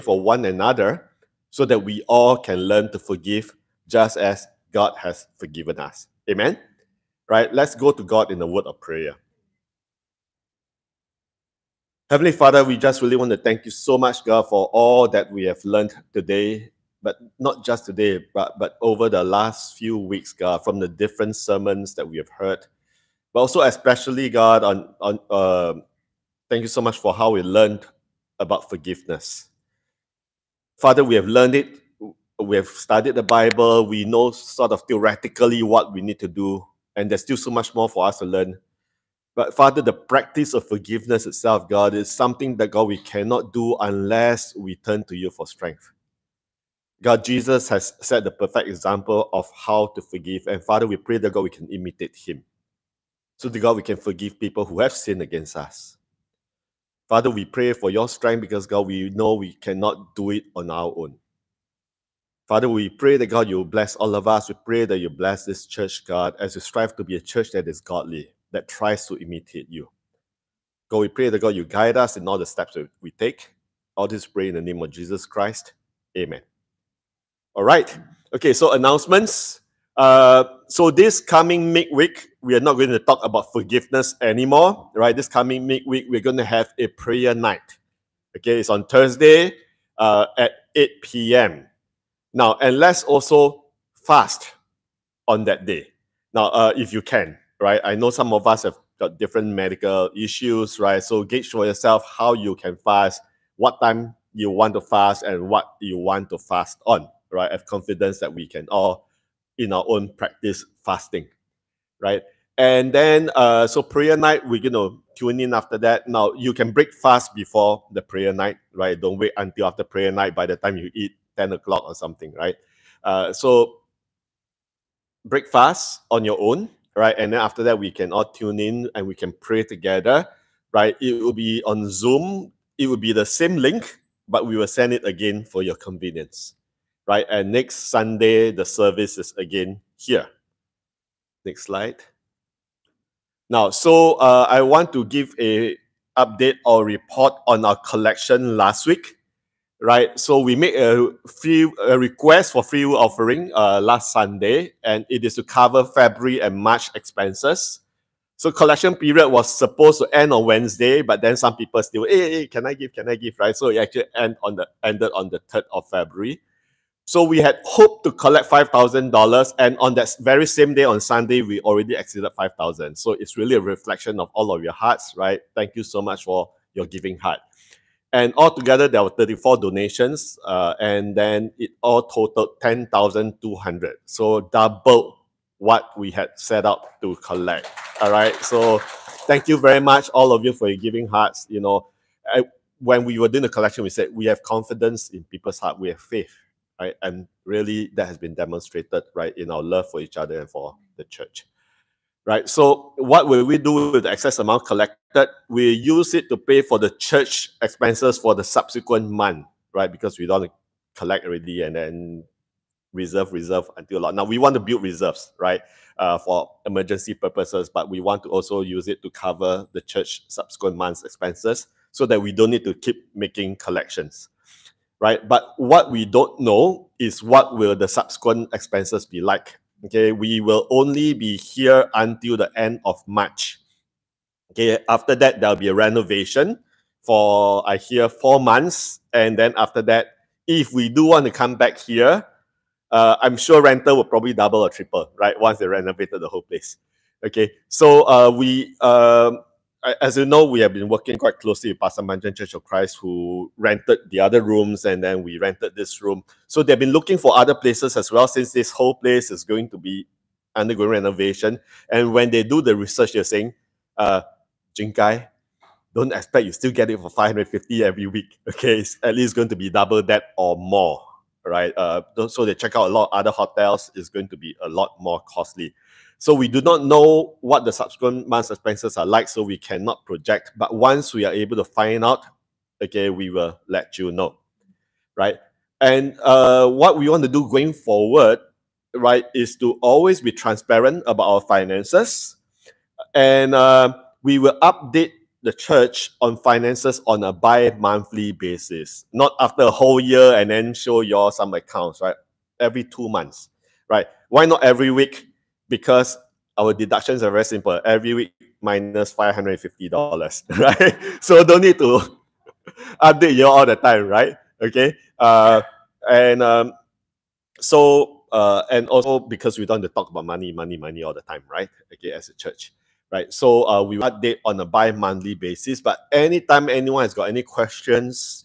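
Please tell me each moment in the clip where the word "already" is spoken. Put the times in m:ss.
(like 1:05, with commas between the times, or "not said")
2:51, 3:31.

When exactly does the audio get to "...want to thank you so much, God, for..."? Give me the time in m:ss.
0:13.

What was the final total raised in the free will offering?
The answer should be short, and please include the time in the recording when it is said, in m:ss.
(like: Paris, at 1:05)
10,200, at 3:02.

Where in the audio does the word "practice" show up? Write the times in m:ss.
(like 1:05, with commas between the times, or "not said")
0:39, 1:50.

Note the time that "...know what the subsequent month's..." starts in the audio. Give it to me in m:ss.
4:36.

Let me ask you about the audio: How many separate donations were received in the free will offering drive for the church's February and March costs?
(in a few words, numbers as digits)
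34.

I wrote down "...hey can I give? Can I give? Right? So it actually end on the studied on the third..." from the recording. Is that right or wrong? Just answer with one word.
wrong.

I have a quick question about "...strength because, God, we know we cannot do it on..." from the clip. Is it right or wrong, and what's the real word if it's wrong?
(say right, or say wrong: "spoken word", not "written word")
right.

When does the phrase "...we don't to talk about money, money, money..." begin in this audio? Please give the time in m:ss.
5:19.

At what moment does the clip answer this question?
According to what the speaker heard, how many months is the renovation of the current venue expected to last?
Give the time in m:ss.
3:58.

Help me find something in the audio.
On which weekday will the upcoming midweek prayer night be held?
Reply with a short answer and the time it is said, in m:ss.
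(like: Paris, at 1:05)
Thursday, at 1:28.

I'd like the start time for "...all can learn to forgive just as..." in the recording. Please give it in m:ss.
0:02.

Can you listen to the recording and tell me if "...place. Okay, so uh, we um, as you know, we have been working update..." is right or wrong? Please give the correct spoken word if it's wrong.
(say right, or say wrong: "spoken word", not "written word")
wrong: "quite", not "update".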